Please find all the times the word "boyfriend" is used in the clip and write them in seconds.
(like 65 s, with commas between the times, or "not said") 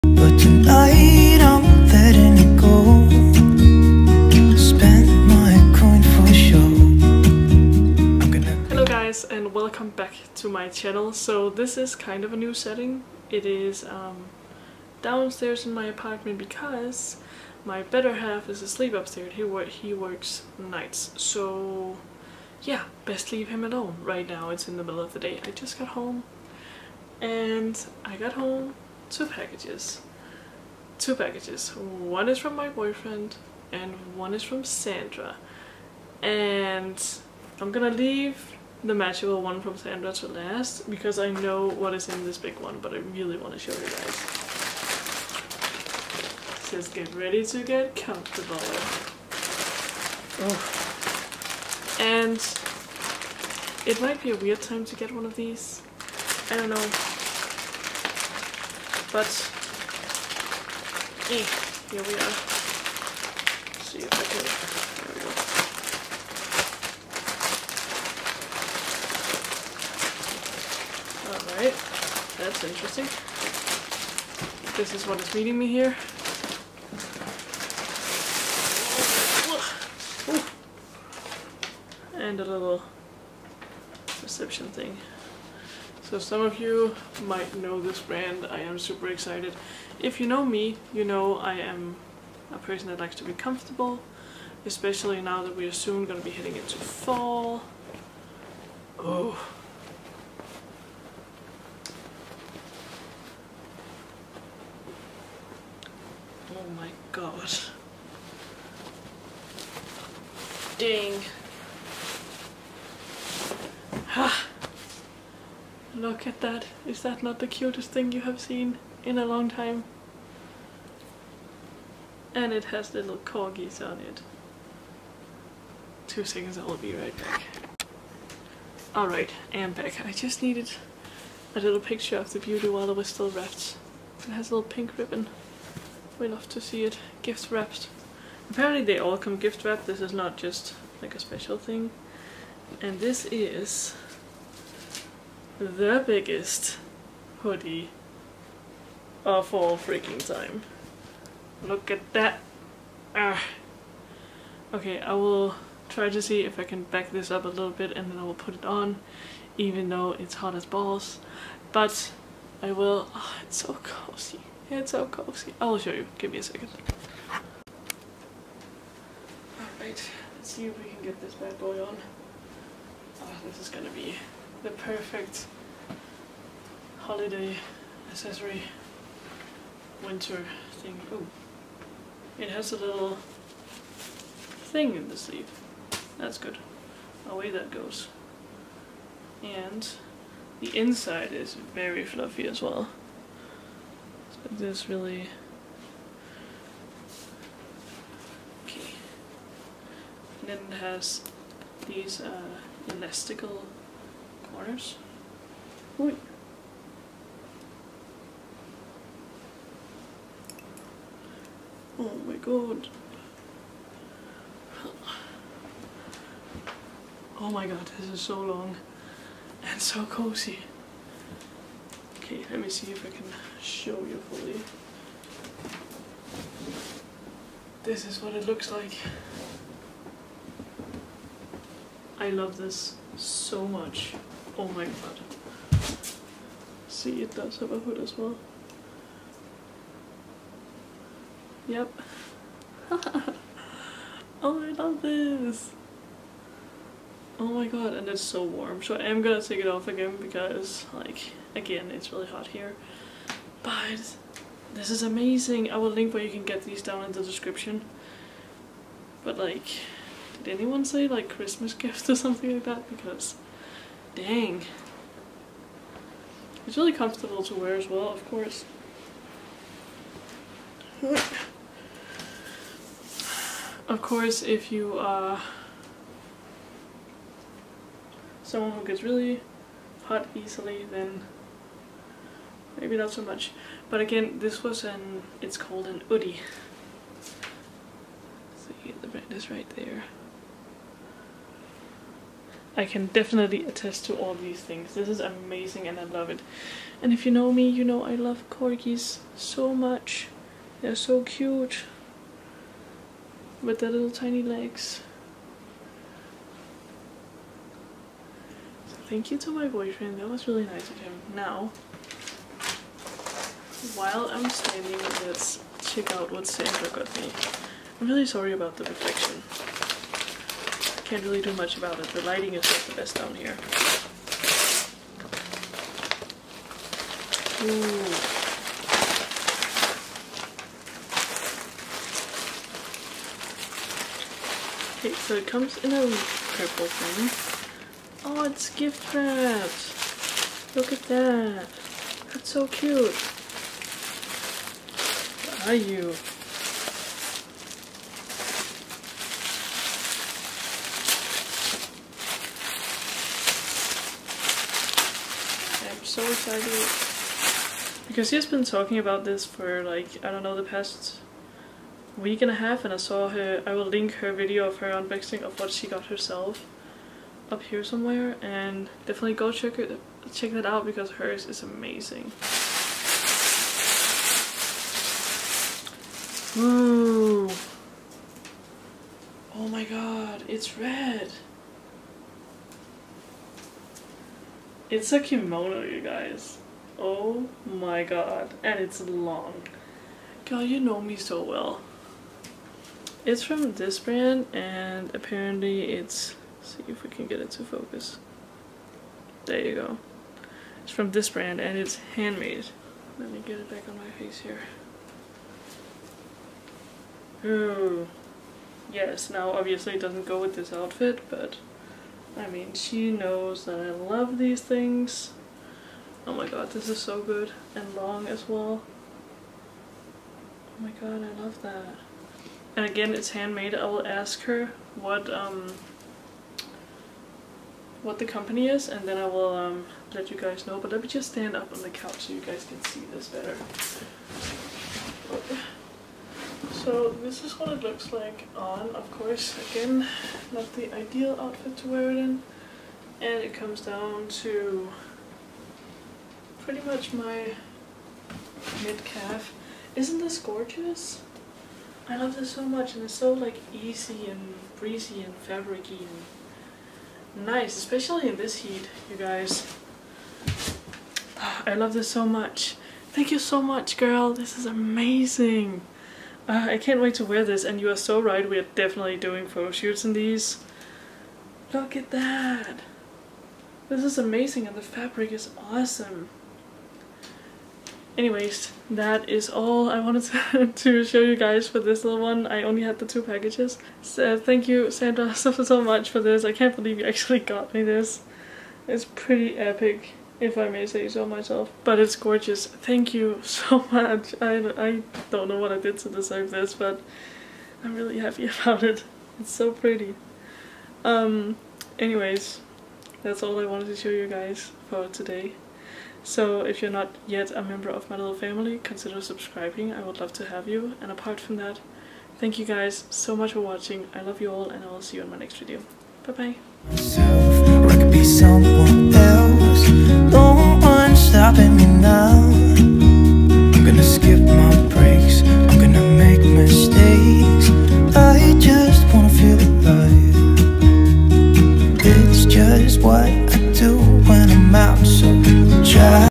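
32 s, 309 s.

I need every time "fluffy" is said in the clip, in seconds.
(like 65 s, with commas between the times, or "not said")
192 s.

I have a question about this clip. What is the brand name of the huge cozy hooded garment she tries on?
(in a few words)
Oodie.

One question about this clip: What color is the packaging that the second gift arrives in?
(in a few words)
purple.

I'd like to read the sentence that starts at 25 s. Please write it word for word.
I just got home and I got home two packages two packages.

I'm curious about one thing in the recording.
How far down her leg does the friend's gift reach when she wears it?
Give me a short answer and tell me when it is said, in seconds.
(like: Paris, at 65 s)
mid-calf, at 448 s.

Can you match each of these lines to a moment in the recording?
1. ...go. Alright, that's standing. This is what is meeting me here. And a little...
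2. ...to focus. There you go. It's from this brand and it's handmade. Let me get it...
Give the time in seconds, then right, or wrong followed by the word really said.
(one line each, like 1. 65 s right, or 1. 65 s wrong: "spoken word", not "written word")
1. 71 s wrong: "interesting", not "standing"
2. 397 s right.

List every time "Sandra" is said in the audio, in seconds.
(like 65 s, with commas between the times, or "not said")
34 s, 39 s, 316 s, 484 s.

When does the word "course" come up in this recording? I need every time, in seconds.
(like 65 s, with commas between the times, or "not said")
268 s, 274 s, 439 s.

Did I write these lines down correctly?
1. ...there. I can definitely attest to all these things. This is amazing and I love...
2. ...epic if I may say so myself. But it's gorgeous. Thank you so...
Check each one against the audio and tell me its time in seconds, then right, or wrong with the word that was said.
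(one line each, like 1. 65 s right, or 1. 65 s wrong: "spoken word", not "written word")
1. 289 s right
2. 489 s right.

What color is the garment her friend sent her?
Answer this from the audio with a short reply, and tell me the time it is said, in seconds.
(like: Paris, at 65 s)
red, at 380 s.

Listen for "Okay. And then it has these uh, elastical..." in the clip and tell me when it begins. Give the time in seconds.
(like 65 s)
198 s.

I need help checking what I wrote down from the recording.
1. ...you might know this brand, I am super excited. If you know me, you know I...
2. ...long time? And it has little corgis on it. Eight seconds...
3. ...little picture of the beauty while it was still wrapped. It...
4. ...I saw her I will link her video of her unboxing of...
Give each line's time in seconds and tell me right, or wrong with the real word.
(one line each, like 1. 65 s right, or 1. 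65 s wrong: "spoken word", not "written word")
1. 86 s right
2. 119 s wrong: "Two", not "Eight"
3. 131 s right
4. 362 s right.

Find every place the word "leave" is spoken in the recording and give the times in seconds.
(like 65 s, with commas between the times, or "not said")
23 s, 37 s.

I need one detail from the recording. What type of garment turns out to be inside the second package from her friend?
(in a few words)
kimono.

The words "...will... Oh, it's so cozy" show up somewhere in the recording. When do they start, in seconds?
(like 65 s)
162 s.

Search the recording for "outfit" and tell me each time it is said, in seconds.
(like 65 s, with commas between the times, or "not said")
410 s, 441 s.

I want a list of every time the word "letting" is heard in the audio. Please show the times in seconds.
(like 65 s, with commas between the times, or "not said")
not said.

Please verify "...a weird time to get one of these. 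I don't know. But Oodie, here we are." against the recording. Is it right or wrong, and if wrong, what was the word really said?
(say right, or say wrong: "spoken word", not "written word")
wrong: "Okay", not "Oodie".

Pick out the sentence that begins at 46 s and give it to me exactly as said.
Just get ready to get comfortable.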